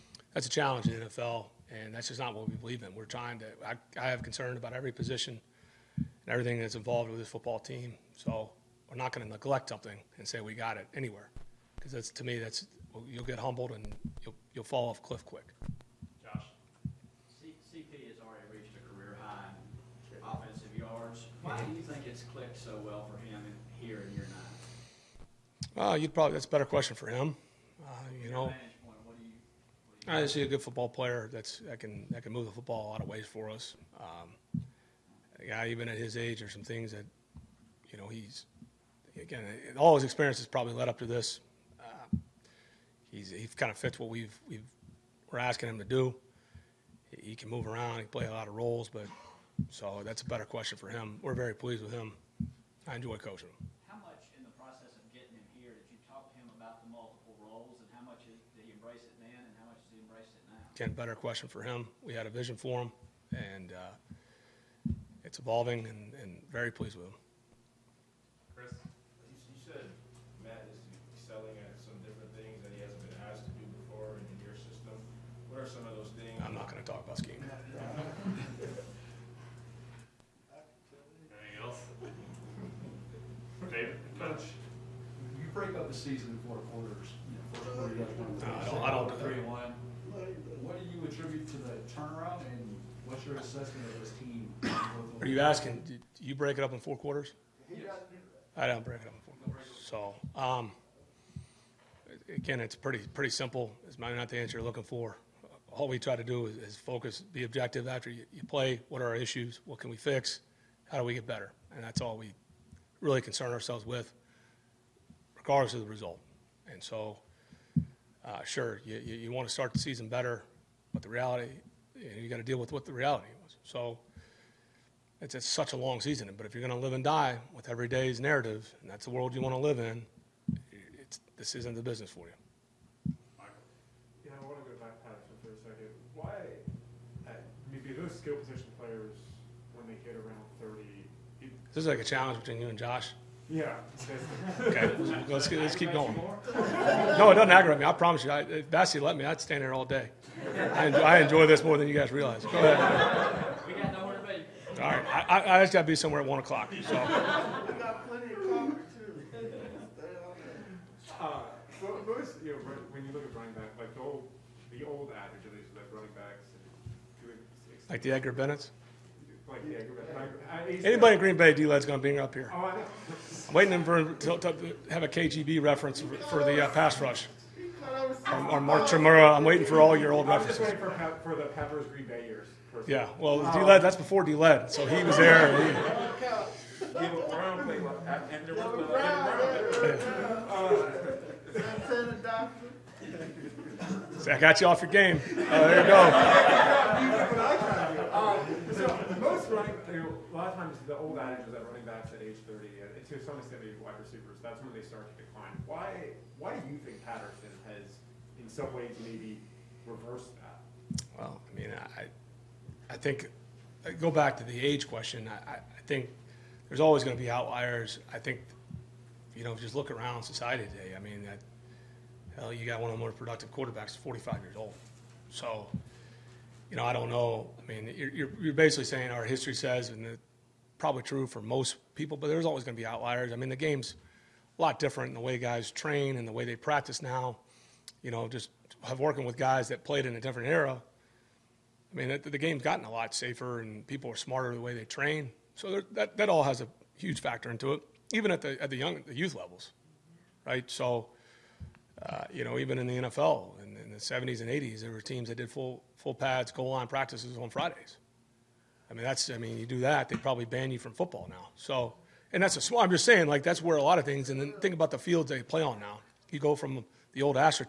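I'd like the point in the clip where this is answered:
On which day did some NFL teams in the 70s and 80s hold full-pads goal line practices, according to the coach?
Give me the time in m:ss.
4:17.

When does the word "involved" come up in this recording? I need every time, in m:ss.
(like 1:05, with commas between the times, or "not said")
0:06.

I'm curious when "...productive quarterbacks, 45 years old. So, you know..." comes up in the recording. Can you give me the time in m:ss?
3:43.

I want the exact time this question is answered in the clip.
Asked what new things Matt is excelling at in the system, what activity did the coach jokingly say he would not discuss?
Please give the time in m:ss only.
1:17.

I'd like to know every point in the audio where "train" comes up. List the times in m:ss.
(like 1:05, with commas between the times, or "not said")
3:55, 4:04.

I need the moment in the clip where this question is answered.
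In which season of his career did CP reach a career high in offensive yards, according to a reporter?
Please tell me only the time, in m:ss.
0:24.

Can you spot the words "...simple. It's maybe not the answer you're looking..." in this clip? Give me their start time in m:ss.
1:43.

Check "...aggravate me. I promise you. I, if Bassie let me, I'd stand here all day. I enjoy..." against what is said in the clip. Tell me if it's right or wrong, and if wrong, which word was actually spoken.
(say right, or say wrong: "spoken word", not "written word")
right.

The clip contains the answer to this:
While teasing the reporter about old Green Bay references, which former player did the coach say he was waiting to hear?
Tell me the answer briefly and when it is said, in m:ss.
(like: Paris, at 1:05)
Mark Chmura, at 2:58.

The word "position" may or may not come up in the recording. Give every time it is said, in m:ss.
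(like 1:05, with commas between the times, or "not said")
0:04, 2:18.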